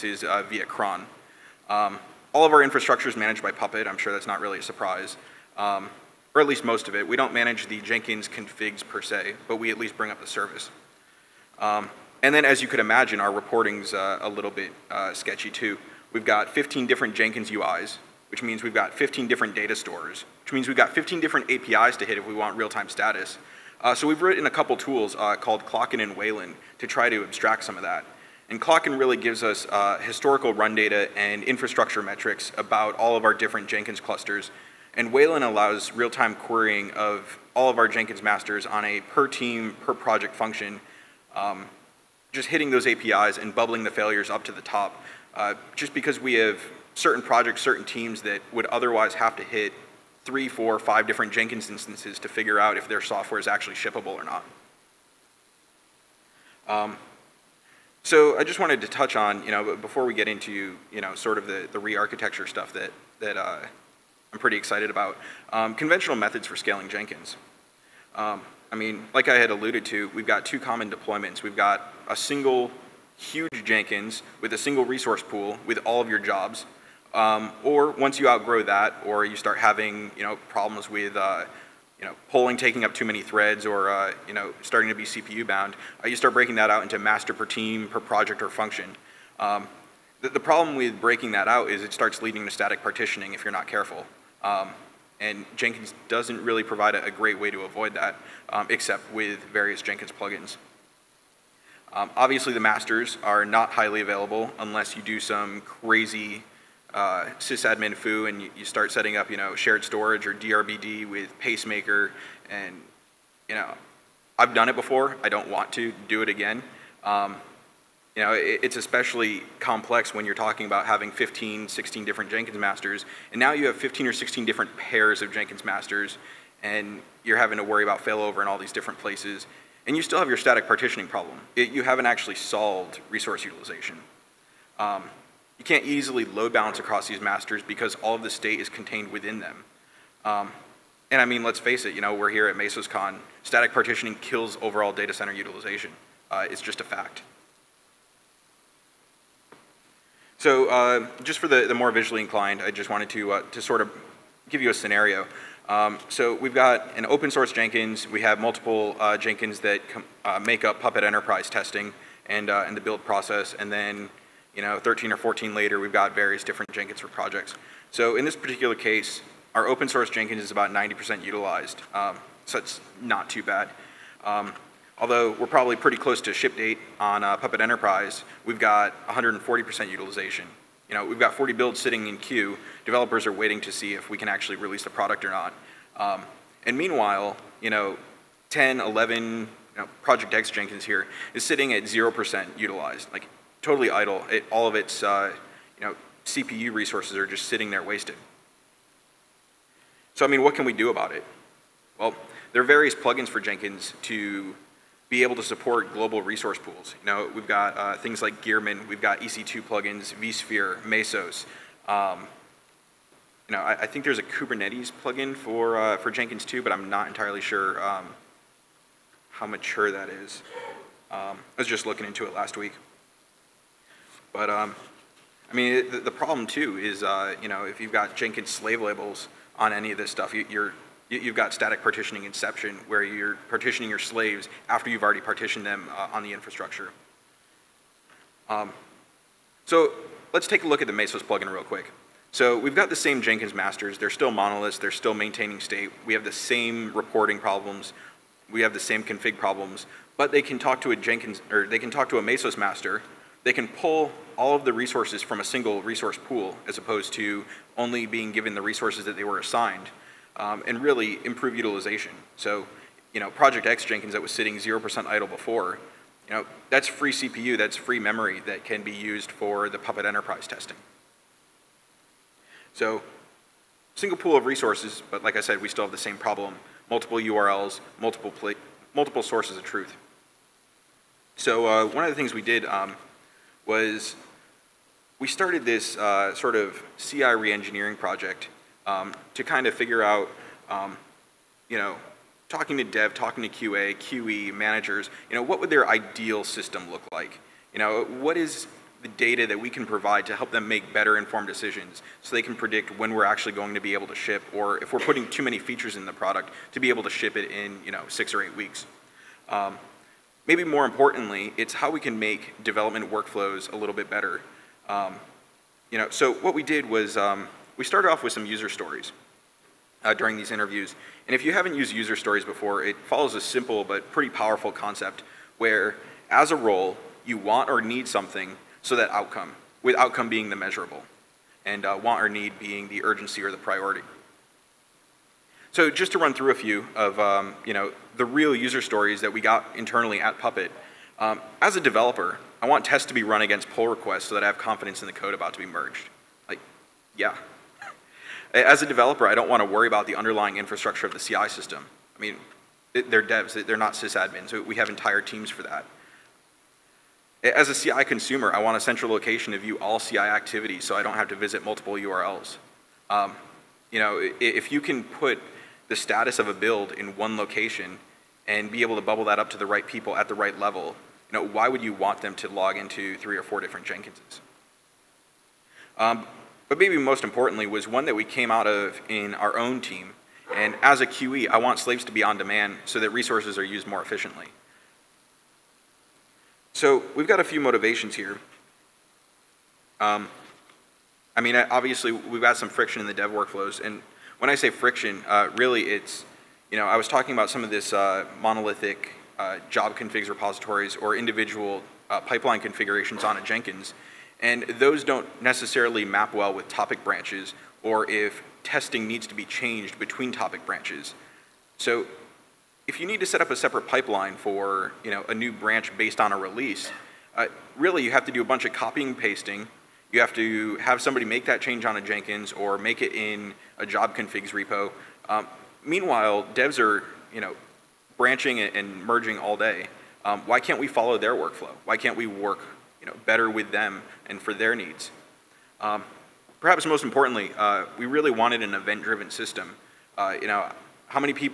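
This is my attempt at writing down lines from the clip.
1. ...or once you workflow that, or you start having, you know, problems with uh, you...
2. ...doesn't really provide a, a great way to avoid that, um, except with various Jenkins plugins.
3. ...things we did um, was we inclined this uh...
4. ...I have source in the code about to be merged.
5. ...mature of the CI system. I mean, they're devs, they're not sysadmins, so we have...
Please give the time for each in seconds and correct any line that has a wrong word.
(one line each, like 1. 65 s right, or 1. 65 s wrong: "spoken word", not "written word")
1. 77 s wrong: "outgrow", not "workflow"
2. 96 s right
3. 282 s wrong: "started", not "inclined"
4. 344 s wrong: "confidence", not "source"
5. 350 s wrong: "infrastructure", not "mature".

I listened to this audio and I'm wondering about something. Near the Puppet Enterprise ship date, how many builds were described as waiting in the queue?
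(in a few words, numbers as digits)
40.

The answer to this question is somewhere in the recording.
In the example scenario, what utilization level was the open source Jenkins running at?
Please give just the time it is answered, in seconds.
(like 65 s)
170 s.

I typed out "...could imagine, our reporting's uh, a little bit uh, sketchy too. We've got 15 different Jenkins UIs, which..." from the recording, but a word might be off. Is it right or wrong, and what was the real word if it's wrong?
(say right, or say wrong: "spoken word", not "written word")
right.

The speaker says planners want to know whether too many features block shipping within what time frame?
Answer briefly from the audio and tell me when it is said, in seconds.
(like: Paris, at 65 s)
6 or 8 weeks, at 308 s.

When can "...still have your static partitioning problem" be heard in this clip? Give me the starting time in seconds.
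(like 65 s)
130 s.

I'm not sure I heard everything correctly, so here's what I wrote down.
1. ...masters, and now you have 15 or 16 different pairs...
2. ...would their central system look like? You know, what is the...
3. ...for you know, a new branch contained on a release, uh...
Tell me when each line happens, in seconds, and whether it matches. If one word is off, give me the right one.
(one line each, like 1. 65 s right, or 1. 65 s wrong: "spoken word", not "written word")
1. 122 s right
2. 295 s wrong: "ideal", not "central"
3. 414 s wrong: "based", not "contained".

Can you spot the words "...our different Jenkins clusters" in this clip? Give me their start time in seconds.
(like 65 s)
33 s.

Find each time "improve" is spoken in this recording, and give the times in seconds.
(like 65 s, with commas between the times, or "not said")
261 s.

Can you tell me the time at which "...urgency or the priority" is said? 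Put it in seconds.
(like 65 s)
333 s.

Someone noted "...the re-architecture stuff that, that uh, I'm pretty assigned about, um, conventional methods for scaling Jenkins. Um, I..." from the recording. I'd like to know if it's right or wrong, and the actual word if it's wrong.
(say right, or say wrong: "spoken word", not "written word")
wrong: "excited", not "assigned".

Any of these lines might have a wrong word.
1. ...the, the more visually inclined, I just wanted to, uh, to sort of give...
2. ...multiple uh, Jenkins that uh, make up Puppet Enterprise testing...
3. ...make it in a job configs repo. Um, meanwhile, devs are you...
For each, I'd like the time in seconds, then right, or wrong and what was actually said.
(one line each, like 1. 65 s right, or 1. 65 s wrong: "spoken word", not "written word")
1. 151 s right
2. 158 s right
3. 422 s right.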